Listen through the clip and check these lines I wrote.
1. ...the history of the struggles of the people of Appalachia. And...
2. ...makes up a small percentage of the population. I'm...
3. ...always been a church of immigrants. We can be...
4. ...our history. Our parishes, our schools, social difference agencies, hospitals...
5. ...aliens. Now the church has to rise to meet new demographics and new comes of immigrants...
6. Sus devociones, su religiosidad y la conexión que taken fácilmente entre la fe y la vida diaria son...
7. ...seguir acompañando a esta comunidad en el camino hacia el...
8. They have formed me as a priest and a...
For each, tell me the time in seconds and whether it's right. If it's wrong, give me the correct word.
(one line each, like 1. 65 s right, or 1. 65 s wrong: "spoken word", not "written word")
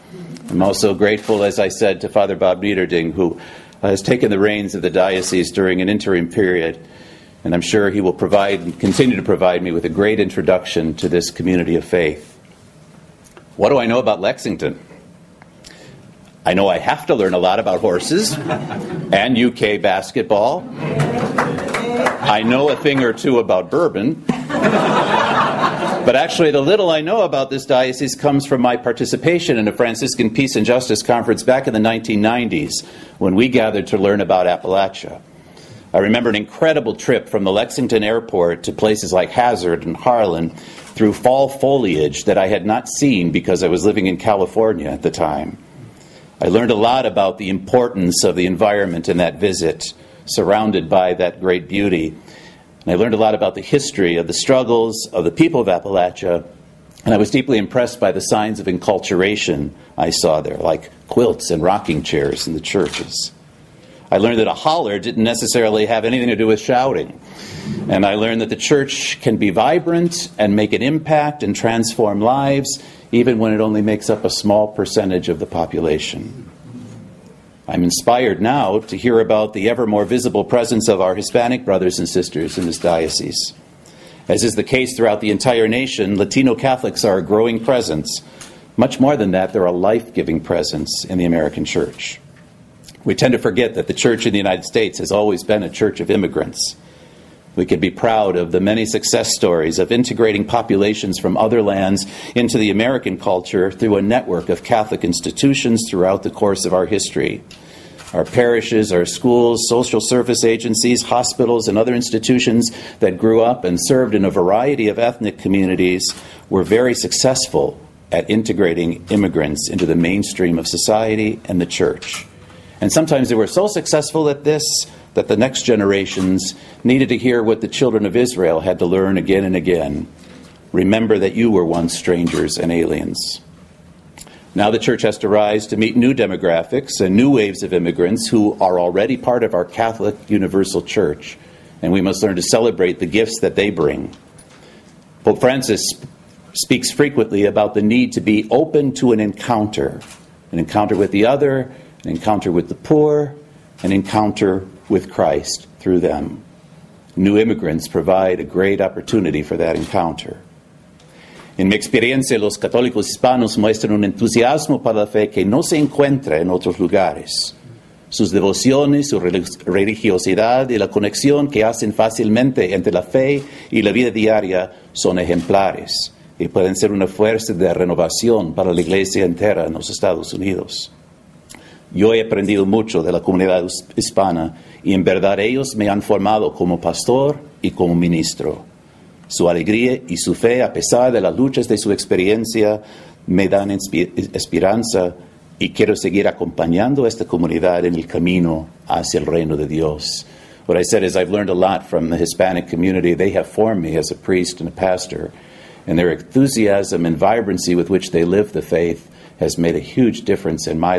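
1. 53 s right
2. 73 s right
3. 95 s right
4. 106 s wrong: "service", not "difference"
5. 132 s wrong: "waves", not "comes"
6. 168 s wrong: "hacen", not "taken"
7. 195 s right
8. 203 s right.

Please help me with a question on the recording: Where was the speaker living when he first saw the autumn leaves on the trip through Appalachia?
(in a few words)
California.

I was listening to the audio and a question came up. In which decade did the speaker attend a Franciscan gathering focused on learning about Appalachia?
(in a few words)
1990s.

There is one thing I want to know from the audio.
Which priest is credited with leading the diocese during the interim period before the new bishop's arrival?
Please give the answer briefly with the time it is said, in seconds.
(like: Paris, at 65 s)
Father Bob Nieberding, at 2 s.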